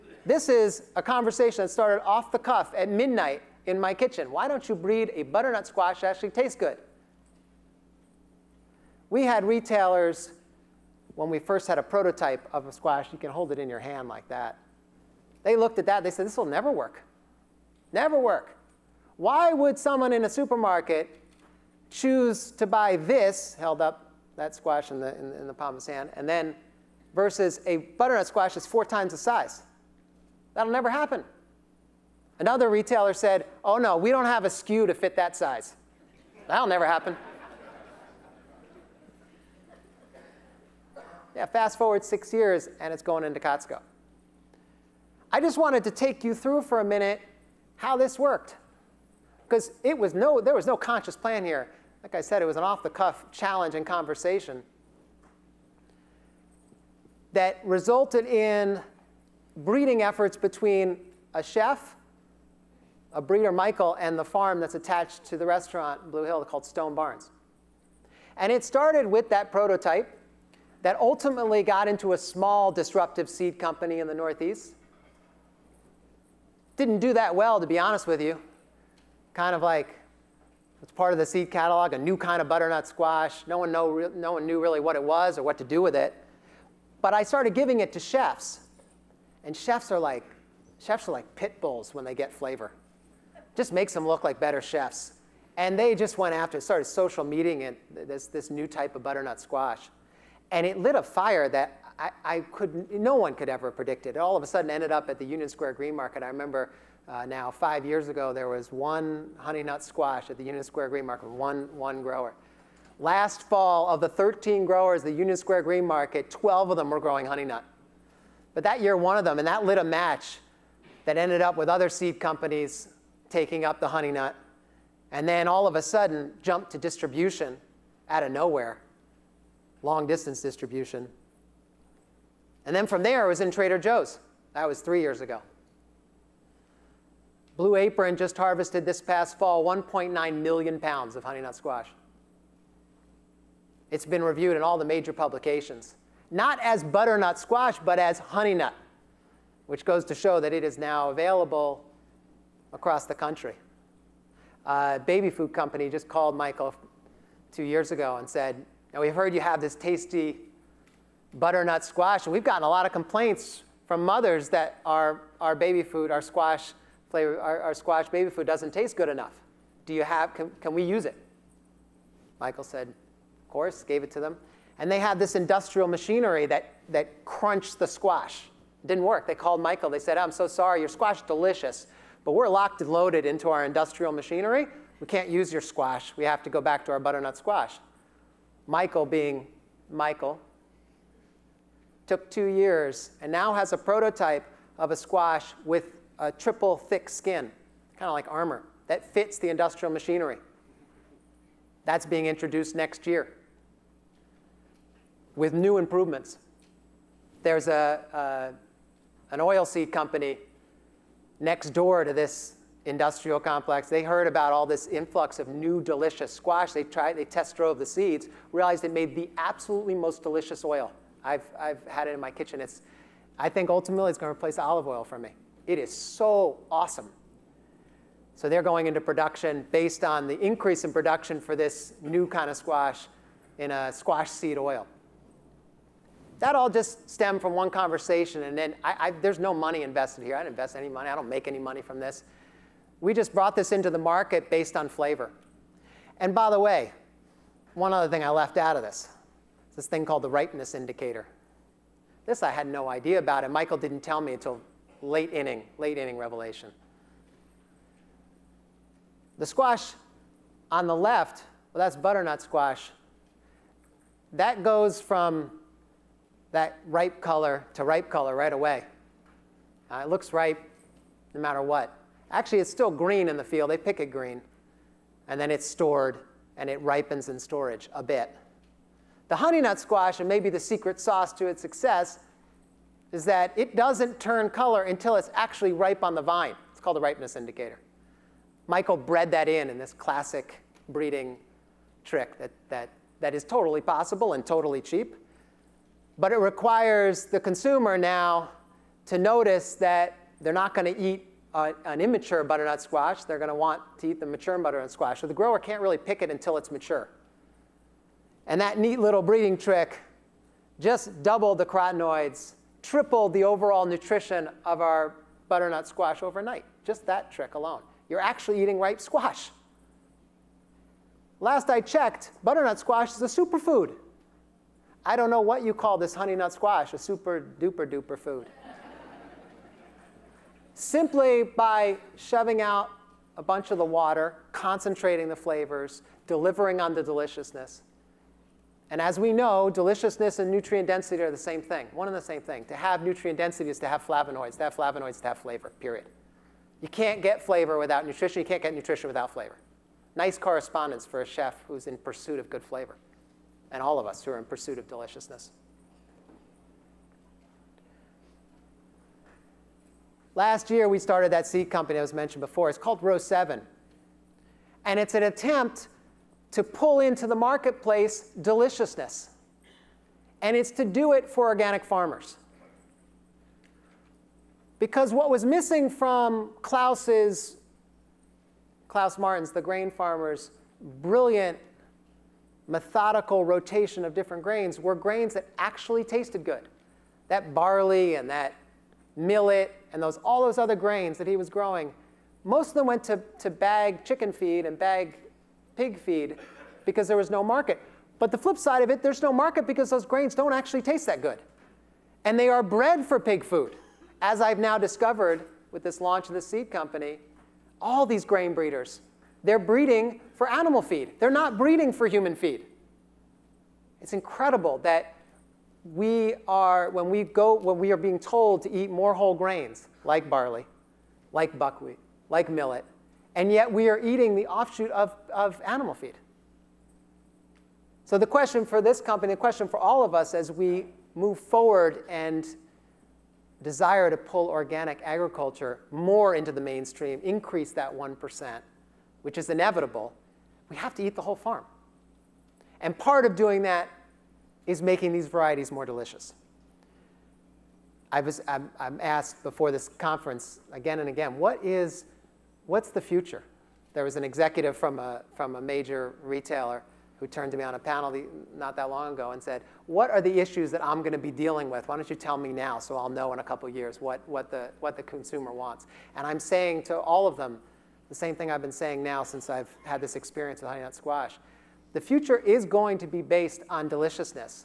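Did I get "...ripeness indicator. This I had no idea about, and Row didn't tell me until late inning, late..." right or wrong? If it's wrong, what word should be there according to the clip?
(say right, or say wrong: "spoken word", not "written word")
wrong: "Michael", not "Row".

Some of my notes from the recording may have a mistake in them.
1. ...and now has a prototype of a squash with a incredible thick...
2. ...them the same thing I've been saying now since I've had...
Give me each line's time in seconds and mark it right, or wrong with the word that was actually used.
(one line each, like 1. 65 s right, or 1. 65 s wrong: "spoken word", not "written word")
1. 193 s wrong: "triple", not "incredible"
2. 467 s right.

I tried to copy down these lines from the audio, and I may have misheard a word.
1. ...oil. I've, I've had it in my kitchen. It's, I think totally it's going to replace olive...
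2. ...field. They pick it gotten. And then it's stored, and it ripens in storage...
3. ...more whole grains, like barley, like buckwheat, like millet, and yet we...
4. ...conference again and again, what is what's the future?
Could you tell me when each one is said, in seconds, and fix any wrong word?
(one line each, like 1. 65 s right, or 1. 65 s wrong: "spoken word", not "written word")
1. 220 s wrong: "ultimately", not "totally"
2. 273 s wrong: "green", not "gotten"
3. 418 s right
4. 449 s right.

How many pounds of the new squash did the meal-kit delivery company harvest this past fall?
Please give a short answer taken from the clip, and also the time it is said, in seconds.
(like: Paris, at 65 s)
1.9 million, at 139 s.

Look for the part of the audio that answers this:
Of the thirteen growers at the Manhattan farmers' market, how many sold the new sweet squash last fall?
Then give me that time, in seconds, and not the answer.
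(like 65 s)
116 s.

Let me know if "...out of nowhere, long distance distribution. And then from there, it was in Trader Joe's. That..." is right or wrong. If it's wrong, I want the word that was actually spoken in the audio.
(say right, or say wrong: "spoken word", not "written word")
right.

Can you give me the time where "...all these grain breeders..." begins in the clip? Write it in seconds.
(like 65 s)
407 s.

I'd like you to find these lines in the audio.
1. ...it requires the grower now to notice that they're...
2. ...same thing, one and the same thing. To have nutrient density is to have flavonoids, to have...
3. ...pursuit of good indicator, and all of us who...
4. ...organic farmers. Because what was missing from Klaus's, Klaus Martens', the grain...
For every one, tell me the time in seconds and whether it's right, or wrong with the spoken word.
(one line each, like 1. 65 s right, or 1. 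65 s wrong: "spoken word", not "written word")
1. 296 s wrong: "consumer", not "grower"
2. 341 s right
3. 351 s wrong: "flavor", not "indicator"
4. 371 s right.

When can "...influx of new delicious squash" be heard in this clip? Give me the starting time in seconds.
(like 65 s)
214 s.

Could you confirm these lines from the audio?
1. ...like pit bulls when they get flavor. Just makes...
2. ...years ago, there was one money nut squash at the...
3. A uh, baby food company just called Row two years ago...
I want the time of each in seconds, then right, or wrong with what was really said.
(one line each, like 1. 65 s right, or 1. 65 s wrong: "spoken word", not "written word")
1. 91 s right
2. 107 s wrong: "honey", not "money"
3. 154 s wrong: "Michael", not "Row".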